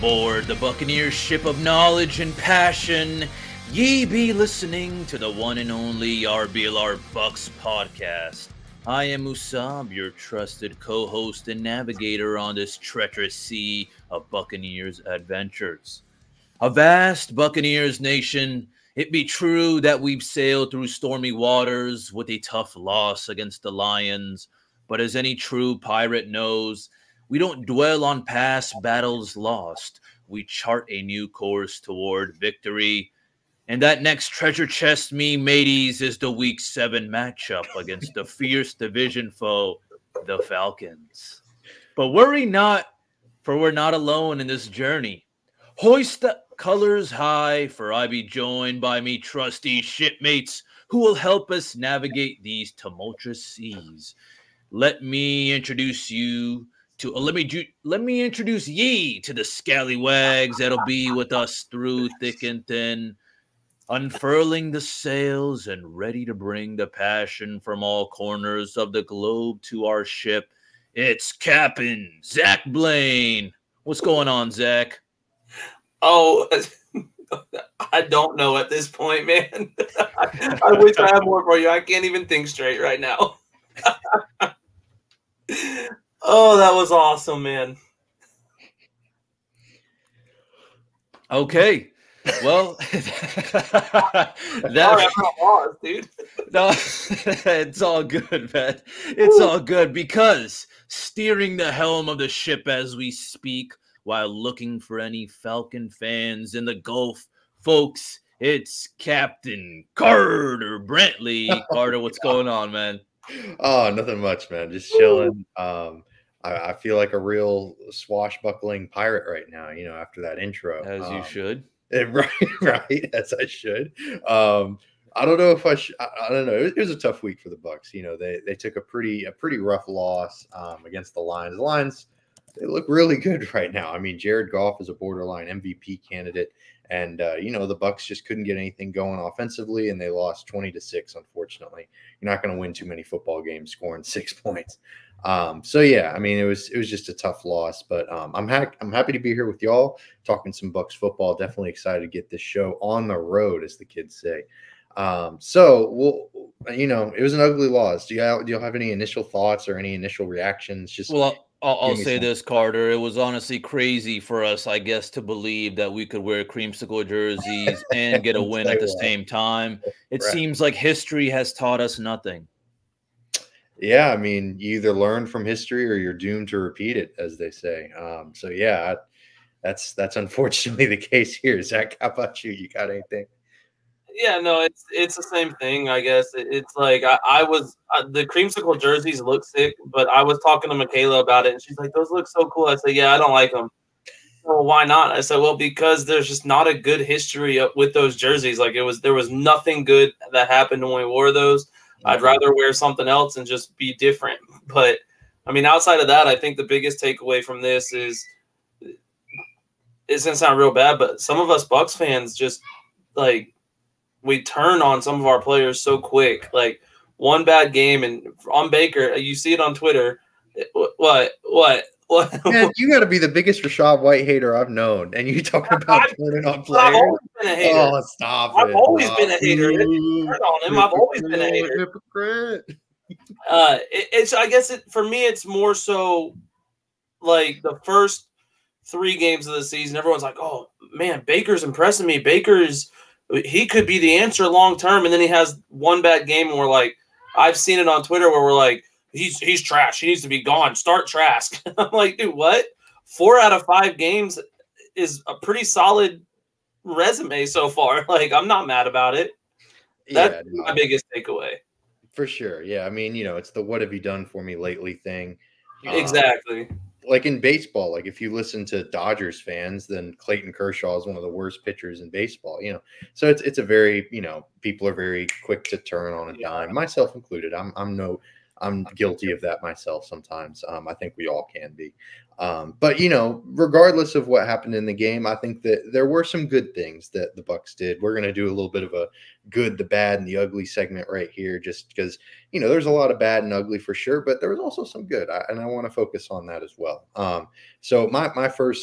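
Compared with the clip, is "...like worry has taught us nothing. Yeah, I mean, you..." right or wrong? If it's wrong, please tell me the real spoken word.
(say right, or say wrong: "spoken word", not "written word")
wrong: "history", not "worry".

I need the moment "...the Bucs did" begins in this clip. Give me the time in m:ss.
4:47.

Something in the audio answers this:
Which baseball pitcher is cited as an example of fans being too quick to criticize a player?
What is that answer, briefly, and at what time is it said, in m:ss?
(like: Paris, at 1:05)
Clayton Kershaw, at 4:30.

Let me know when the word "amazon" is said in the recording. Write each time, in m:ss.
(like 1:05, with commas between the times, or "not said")
not said.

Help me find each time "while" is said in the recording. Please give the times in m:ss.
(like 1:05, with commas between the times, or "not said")
1:44.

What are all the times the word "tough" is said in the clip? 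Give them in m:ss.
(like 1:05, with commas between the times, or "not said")
0:22, 2:06, 2:27.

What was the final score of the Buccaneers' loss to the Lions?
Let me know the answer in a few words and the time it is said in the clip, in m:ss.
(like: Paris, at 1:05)
20 to 6, at 2:20.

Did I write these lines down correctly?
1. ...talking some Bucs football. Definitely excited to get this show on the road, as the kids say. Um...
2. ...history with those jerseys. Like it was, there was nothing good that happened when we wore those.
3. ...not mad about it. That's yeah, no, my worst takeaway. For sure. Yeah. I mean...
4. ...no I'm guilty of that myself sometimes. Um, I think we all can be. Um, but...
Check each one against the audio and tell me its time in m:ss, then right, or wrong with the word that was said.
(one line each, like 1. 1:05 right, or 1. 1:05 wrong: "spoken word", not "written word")
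1. 2:30 right
2. 3:17 right
3. 4:18 wrong: "biggest", not "worst"
4. 4:37 right.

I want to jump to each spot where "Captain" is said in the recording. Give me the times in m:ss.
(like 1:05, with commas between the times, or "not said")
1:11, 1:48.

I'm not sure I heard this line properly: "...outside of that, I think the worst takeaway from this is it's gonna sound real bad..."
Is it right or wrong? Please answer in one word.
wrong.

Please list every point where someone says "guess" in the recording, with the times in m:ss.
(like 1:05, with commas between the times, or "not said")
2:44, 3:05, 3:54.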